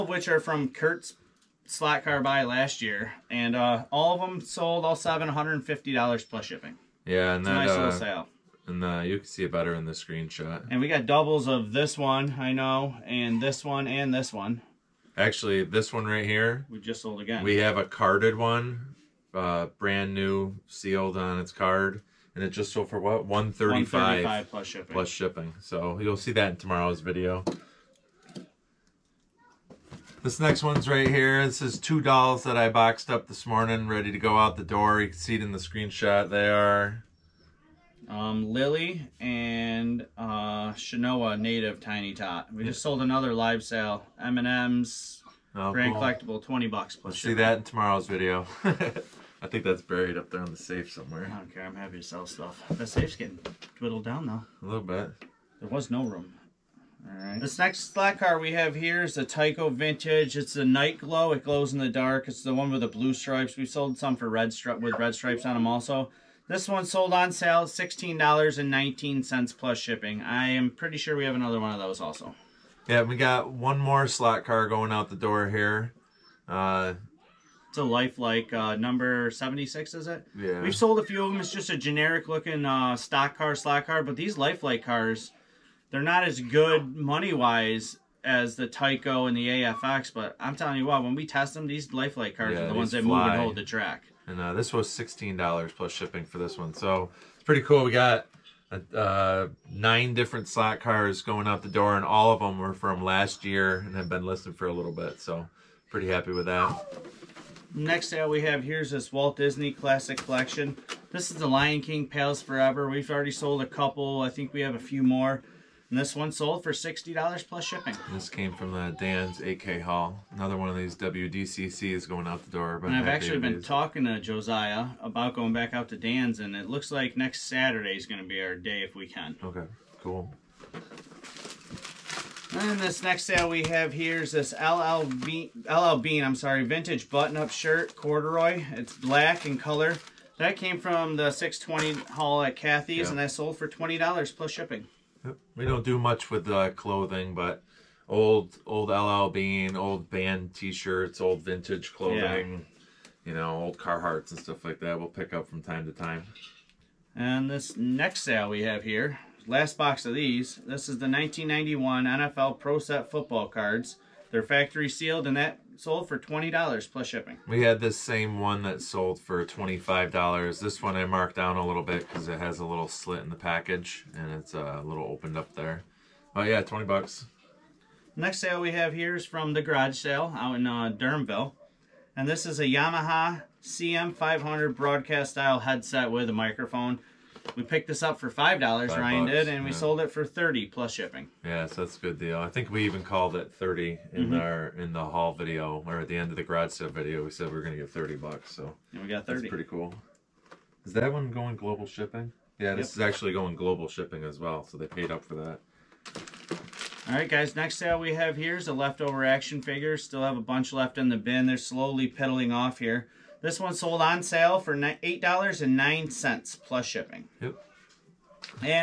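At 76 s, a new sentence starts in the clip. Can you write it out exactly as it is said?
Uh, it's a lifelike uh, number 76, is it?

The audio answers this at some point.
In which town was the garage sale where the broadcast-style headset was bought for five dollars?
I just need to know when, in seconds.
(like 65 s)
180 s.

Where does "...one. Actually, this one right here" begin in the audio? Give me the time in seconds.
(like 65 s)
14 s.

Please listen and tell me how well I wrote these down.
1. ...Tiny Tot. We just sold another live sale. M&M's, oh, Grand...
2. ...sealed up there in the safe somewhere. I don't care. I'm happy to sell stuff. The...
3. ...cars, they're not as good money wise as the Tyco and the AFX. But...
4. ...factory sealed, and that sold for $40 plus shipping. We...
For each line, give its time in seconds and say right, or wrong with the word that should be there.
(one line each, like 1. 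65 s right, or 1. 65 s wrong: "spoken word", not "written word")
1. 41 s right
2. 49 s wrong: "buried", not "sealed"
3. 84 s right
4. 164 s wrong: "20", not "40".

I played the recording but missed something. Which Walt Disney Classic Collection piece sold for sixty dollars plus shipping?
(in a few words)
Lion King Palace Forever.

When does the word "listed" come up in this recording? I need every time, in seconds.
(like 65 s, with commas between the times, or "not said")
104 s.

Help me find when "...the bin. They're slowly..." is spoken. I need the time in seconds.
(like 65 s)
211 s.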